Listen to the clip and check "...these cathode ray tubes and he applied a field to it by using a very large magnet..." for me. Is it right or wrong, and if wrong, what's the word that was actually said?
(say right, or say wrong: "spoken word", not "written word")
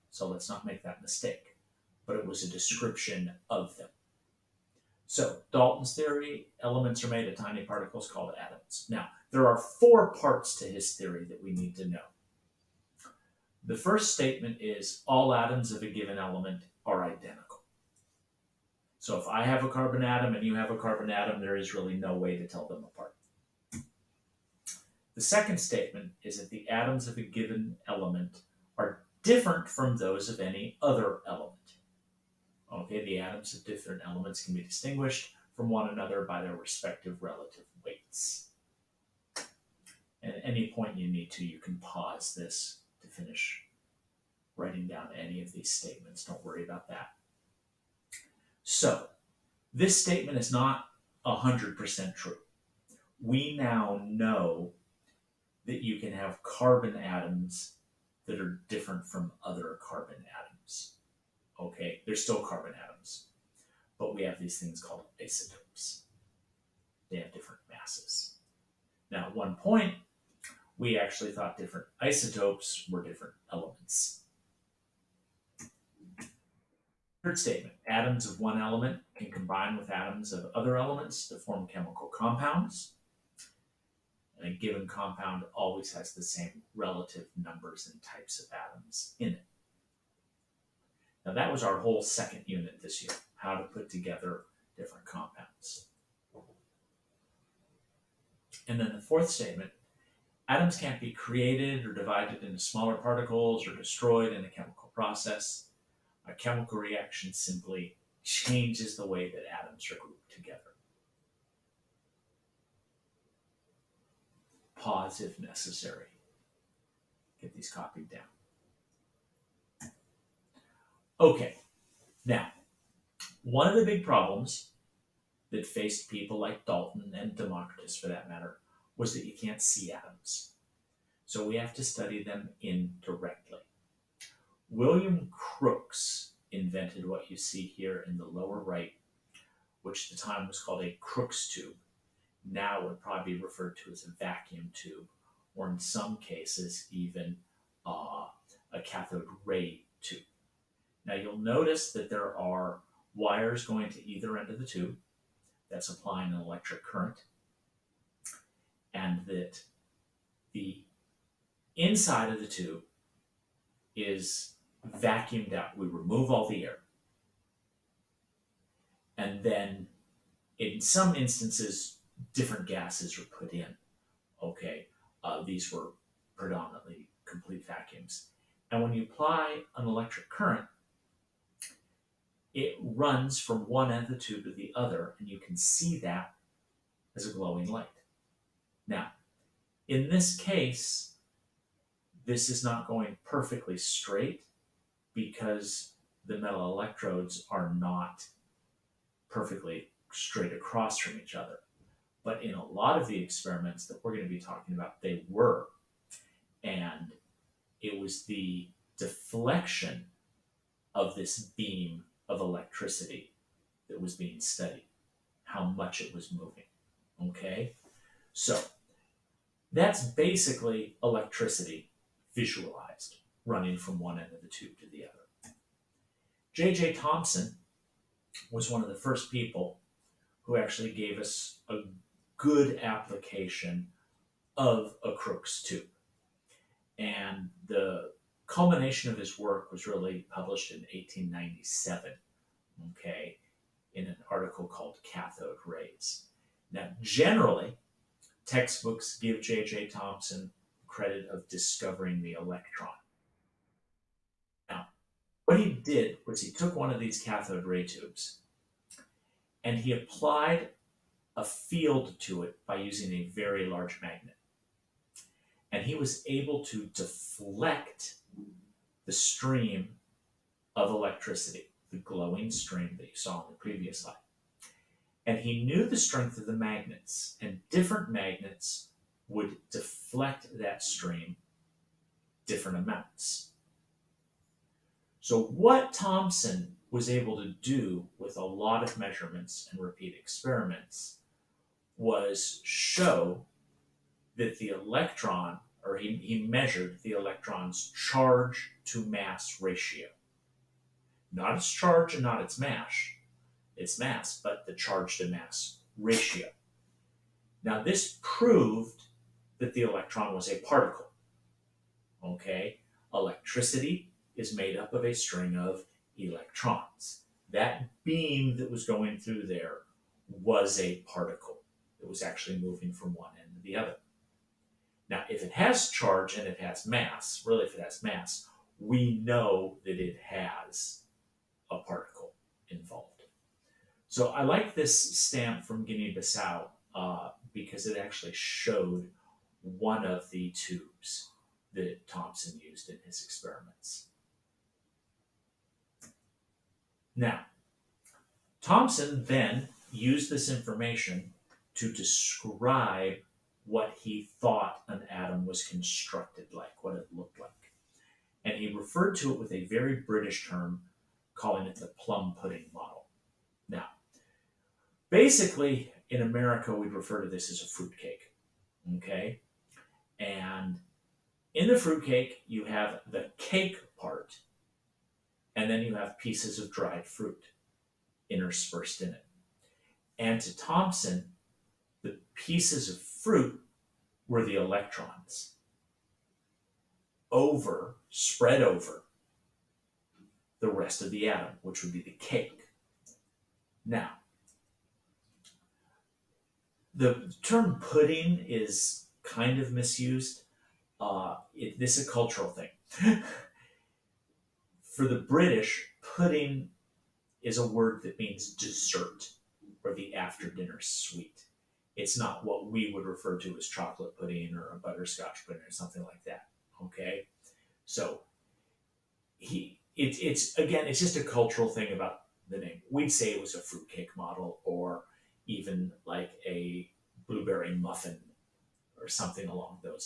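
right.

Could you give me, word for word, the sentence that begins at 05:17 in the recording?
That beam that was going through there was a particle.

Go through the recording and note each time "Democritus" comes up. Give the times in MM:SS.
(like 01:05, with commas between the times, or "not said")
02:07.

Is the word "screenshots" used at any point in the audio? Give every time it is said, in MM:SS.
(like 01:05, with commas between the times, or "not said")
not said.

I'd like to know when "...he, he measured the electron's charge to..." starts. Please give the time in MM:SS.
04:55.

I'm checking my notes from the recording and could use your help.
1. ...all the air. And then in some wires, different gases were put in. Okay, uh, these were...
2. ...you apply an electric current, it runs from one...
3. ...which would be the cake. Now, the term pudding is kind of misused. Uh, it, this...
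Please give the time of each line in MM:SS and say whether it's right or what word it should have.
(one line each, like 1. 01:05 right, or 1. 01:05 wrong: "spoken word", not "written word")
1. 02:46 wrong: "instances", not "wires"
2. 02:58 right
3. 06:31 right.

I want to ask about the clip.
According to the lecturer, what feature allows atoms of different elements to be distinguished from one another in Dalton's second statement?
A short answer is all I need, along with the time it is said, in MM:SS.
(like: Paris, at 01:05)
relative weights, at 00:37.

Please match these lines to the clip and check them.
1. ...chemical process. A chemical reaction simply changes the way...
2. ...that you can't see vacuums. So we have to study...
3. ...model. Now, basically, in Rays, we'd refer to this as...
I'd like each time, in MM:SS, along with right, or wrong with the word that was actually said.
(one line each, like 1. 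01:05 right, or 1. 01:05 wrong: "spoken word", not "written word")
1. 01:44 right
2. 02:09 wrong: "atoms", not "vacuums"
3. 06:02 wrong: "America", not "Rays".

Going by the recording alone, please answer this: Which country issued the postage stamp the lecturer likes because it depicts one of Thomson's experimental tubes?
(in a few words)
Guinea-Bissau.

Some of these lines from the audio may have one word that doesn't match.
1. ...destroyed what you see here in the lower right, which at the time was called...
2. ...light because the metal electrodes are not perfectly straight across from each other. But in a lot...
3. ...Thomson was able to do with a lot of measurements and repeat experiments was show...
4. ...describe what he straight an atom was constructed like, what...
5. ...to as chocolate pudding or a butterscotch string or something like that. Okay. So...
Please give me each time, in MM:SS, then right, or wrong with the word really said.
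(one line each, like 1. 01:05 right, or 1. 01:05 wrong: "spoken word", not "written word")
1. 02:16 wrong: "invented", not "destroyed"
2. 03:13 wrong: "straight", not "light"
3. 04:45 right
4. 05:51 wrong: "thought", not "straight"
5. 06:53 wrong: "pudding", not "string".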